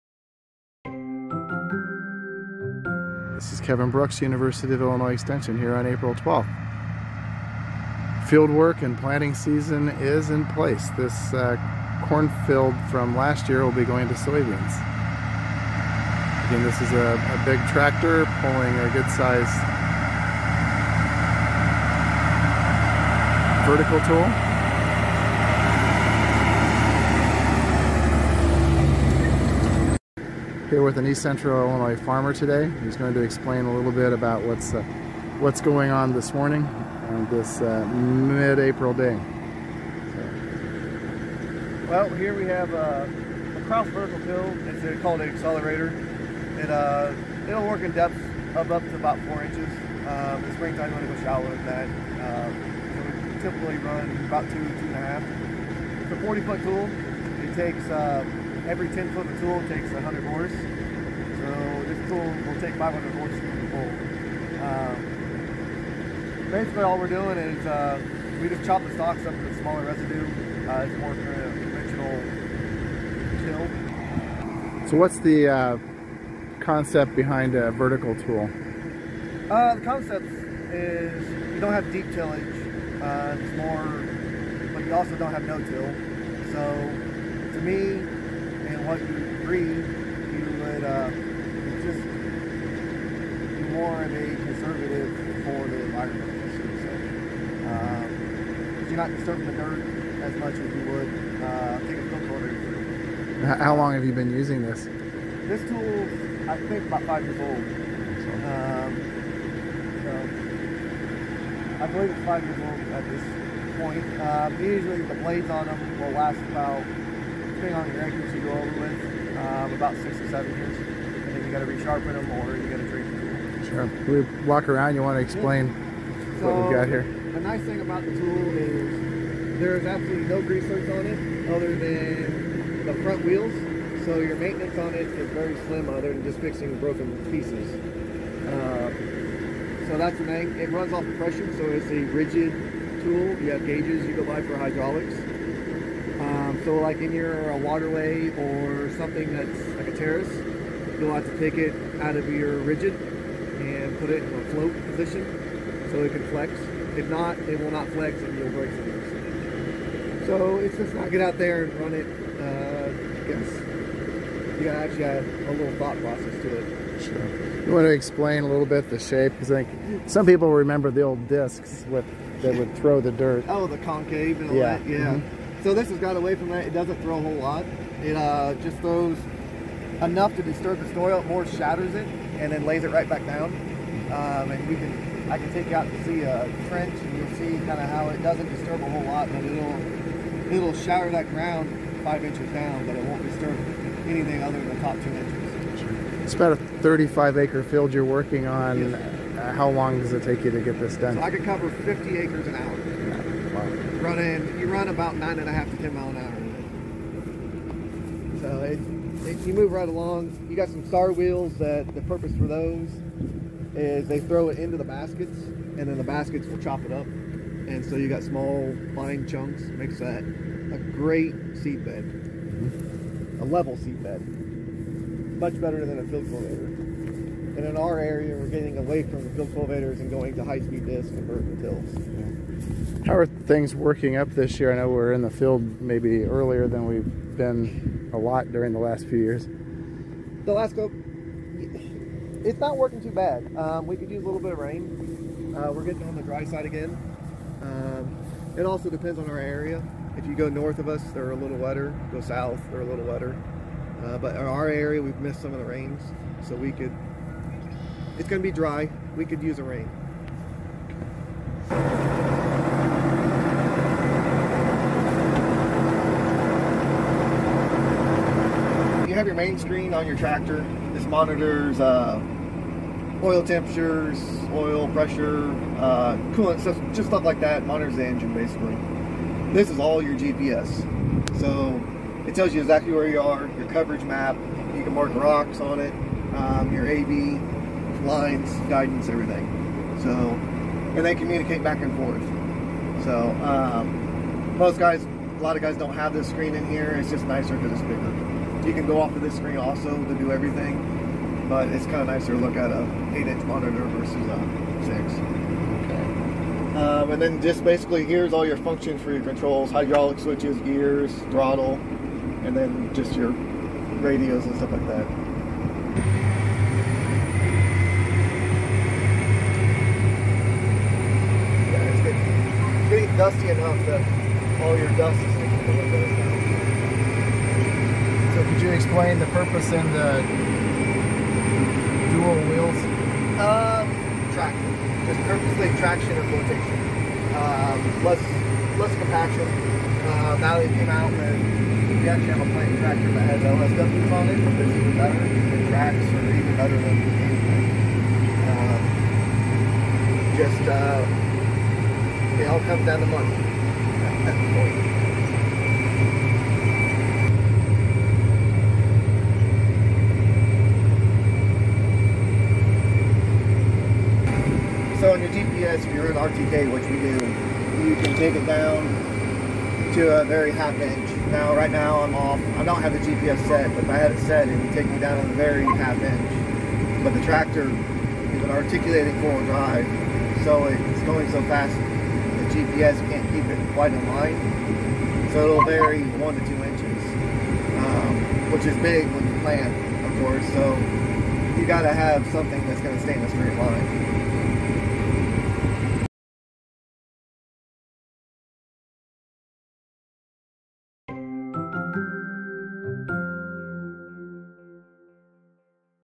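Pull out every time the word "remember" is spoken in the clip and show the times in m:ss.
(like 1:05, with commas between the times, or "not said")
2:50.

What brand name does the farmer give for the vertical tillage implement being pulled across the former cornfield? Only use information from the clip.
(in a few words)
Krause.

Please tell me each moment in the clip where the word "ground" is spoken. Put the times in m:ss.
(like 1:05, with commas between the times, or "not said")
3:11.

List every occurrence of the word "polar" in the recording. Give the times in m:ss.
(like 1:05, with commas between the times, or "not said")
not said.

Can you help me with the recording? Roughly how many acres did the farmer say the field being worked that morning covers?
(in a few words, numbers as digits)
35 acres.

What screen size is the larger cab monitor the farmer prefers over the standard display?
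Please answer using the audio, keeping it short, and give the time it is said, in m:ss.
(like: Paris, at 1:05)
8-inch, at 5:03.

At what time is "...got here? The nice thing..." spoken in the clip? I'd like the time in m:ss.
2:06.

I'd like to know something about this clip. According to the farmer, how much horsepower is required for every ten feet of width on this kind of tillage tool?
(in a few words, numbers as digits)
100 horse.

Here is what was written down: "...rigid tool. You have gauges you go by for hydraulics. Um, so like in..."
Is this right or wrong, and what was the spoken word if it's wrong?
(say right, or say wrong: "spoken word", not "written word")
right.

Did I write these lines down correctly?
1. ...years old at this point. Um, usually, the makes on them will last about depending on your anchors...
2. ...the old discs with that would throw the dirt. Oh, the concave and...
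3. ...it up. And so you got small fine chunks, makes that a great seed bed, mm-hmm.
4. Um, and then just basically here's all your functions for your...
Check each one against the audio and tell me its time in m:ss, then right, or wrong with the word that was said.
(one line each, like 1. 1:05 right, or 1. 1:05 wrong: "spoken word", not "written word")
1. 1:52 wrong: "blades", not "makes"
2. 2:50 right
3. 3:36 right
4. 5:06 right.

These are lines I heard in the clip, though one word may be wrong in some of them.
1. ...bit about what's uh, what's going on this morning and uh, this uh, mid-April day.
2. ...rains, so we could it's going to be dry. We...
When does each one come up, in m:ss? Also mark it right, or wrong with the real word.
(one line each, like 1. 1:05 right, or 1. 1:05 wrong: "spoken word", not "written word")
1. 0:33 right
2. 4:15 right.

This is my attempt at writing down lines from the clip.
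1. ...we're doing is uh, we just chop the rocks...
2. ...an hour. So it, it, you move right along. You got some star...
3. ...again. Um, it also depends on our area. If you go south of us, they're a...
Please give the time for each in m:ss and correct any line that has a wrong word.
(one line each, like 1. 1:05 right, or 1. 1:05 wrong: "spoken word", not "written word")
1. 1:06 wrong: "stalks", not "rocks"
2. 3:26 right
3. 4:06 wrong: "north", not "south".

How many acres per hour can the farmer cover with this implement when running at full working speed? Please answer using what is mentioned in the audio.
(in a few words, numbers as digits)
50 acres.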